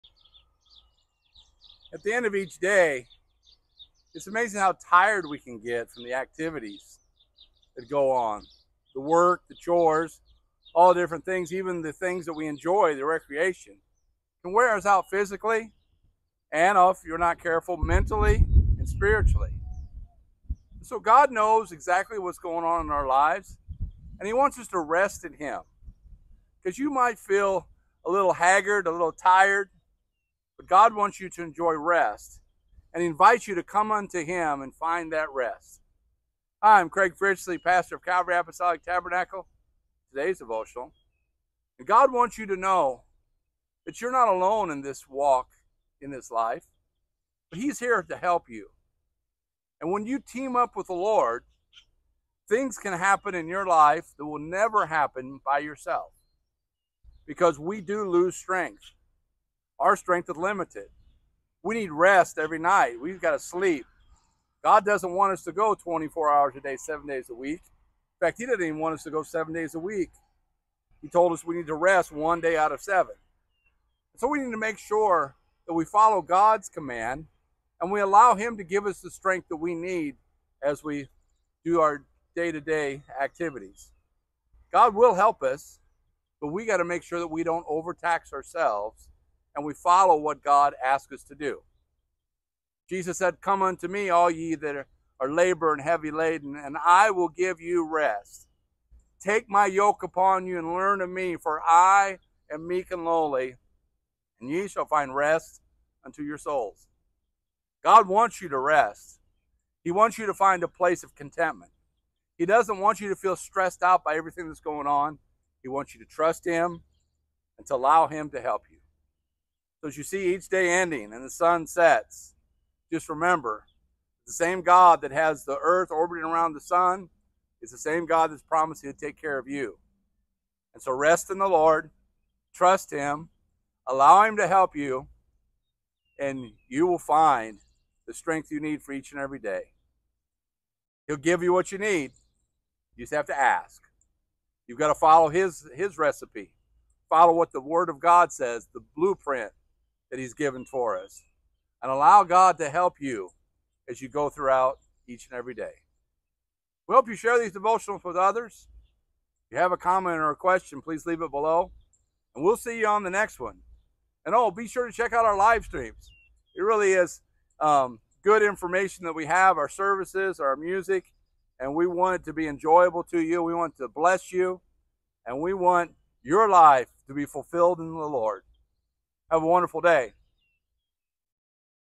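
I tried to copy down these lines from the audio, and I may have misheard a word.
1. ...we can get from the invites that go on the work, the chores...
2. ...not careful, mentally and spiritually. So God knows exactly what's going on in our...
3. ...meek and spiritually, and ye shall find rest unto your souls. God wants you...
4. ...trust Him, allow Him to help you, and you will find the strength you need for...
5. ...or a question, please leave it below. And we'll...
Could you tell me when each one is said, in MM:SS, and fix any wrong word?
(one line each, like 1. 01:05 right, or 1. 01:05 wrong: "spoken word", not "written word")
1. 00:05 wrong: "activities", not "invites"
2. 00:17 right
3. 01:42 wrong: "lowly", not "spiritually"
4. 02:12 right
5. 02:40 right.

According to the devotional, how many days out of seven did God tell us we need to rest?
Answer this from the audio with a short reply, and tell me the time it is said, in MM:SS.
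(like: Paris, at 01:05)
1, at 01:12.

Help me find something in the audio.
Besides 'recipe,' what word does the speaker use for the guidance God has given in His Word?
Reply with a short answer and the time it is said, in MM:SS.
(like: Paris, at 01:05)
blueprint, at 02:28.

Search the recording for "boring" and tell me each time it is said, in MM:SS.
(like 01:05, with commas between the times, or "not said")
not said.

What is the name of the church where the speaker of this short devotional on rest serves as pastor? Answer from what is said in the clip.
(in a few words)
Calvary Apostolic Tabernacle.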